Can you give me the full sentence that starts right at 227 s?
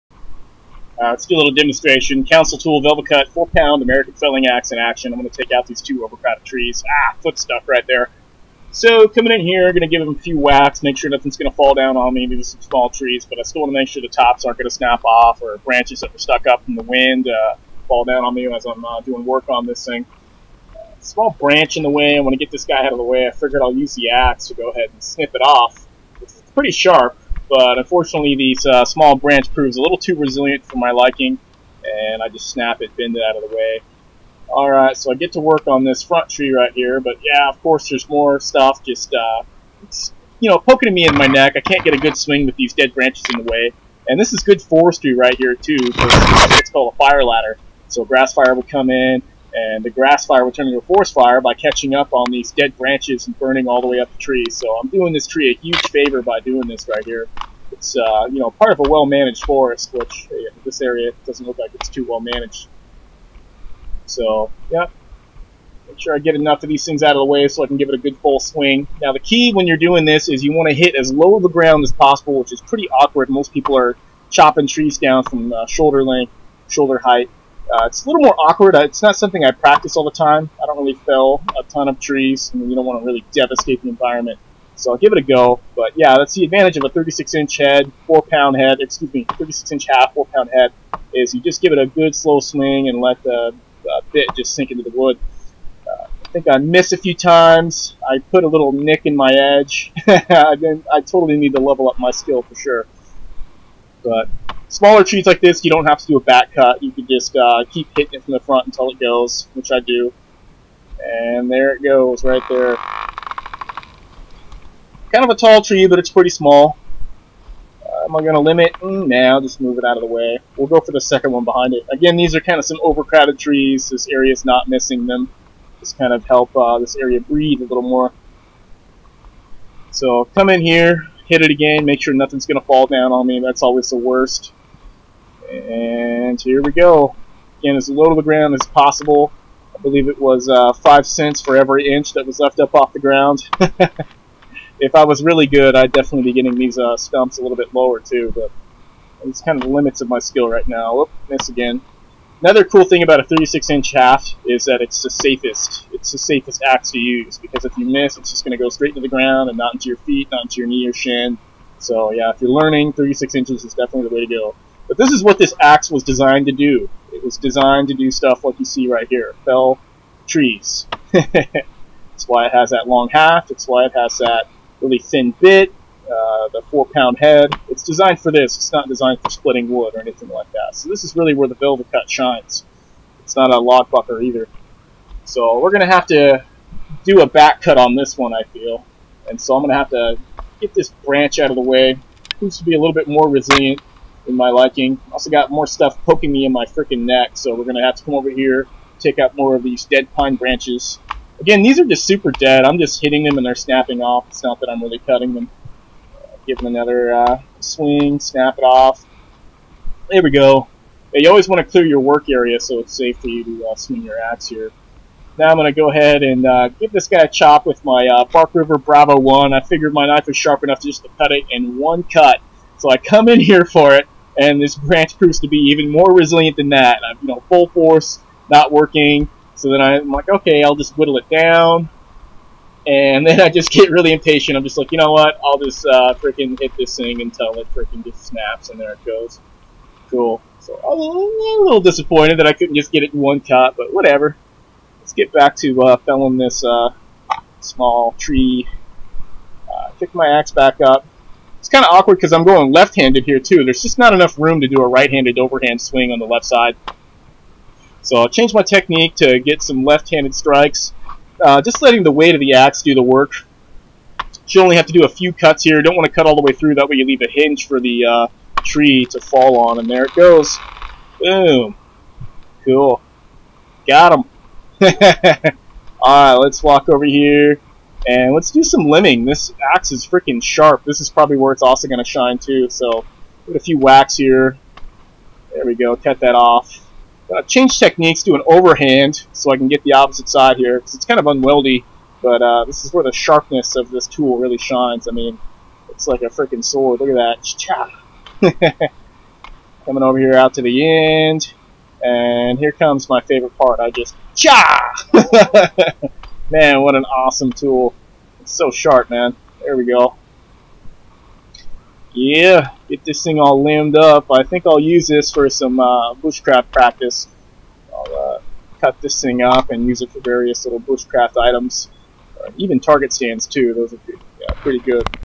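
I'm, you know, full force, not working, so then I'm like, okay, I'll just whittle it down.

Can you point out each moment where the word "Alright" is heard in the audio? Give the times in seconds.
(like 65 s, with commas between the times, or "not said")
34 s, 276 s.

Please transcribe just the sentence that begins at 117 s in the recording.
Uh, am I going to limit?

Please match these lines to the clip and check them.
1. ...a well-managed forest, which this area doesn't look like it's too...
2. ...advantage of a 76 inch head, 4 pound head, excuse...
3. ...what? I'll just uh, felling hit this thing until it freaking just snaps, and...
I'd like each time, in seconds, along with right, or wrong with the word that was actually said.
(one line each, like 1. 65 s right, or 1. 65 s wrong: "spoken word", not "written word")
1. 58 s right
2. 86 s wrong: "36", not "76"
3. 235 s wrong: "freaking", not "felling".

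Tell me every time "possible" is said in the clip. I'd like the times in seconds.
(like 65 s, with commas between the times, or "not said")
71 s, 138 s.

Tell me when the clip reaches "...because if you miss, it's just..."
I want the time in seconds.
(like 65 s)
157 s.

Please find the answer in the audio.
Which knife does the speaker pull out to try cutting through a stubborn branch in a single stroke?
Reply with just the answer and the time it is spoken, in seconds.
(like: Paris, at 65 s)
Bark River Bravo 1, at 218 s.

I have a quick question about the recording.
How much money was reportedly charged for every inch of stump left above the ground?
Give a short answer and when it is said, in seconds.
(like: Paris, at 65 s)
5 cents, at 140 s.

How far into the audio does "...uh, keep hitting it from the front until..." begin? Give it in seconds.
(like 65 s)
107 s.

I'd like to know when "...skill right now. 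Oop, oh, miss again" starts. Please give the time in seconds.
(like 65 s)
150 s.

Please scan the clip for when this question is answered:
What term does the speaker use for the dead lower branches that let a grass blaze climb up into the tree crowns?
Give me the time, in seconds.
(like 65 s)
46 s.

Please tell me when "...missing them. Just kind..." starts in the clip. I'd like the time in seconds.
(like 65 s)
124 s.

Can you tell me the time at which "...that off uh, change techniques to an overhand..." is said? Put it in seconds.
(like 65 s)
286 s.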